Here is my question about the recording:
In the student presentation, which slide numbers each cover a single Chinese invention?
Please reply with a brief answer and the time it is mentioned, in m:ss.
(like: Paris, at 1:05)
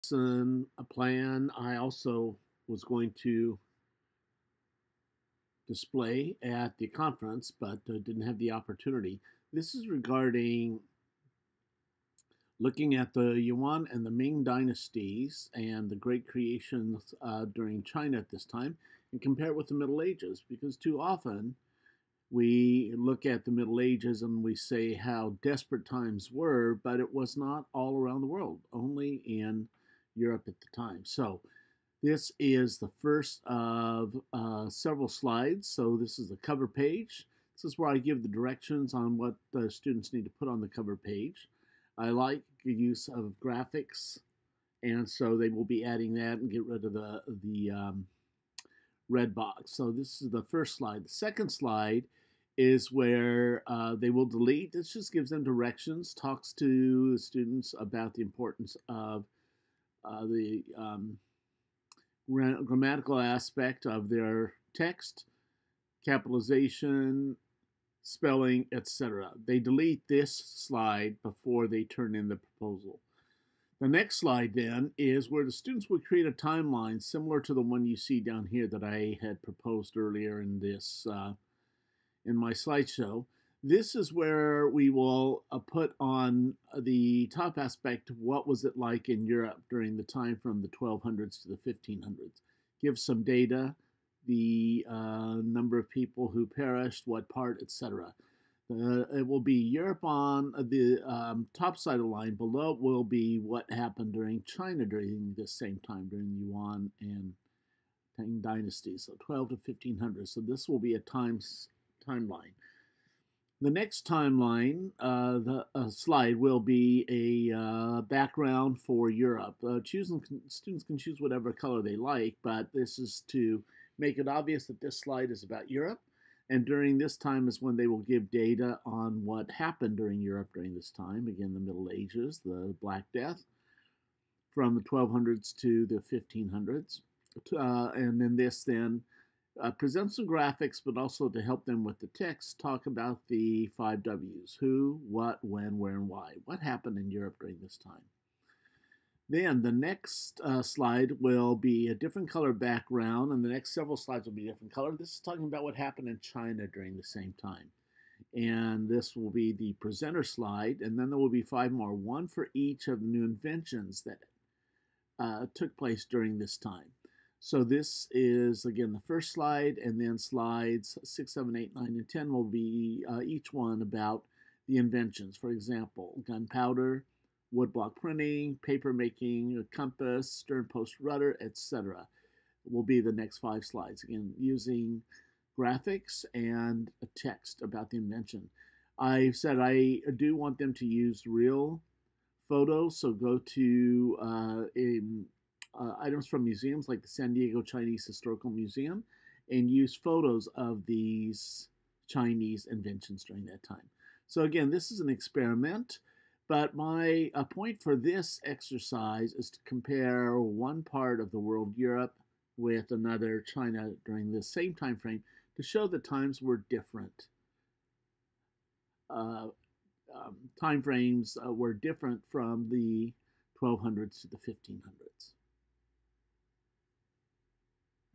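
6, 7, 8, 9, and 10, at 2:51.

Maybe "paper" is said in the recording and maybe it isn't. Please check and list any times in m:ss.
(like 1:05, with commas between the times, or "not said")
2:58.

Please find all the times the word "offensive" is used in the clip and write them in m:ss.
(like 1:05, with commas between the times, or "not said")
not said.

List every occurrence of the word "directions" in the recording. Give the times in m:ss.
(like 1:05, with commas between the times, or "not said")
0:38, 0:55.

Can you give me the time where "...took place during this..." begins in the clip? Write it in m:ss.
2:45.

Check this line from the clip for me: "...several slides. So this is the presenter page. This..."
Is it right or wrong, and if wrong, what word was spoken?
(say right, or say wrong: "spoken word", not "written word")
wrong: "cover", not "presenter".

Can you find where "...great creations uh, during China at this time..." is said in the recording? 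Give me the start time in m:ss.
0:15.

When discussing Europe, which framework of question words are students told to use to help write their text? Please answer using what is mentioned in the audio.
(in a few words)
five W's.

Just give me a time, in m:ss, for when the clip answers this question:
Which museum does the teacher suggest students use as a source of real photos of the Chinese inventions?
3:17.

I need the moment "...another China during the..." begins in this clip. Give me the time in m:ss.
3:32.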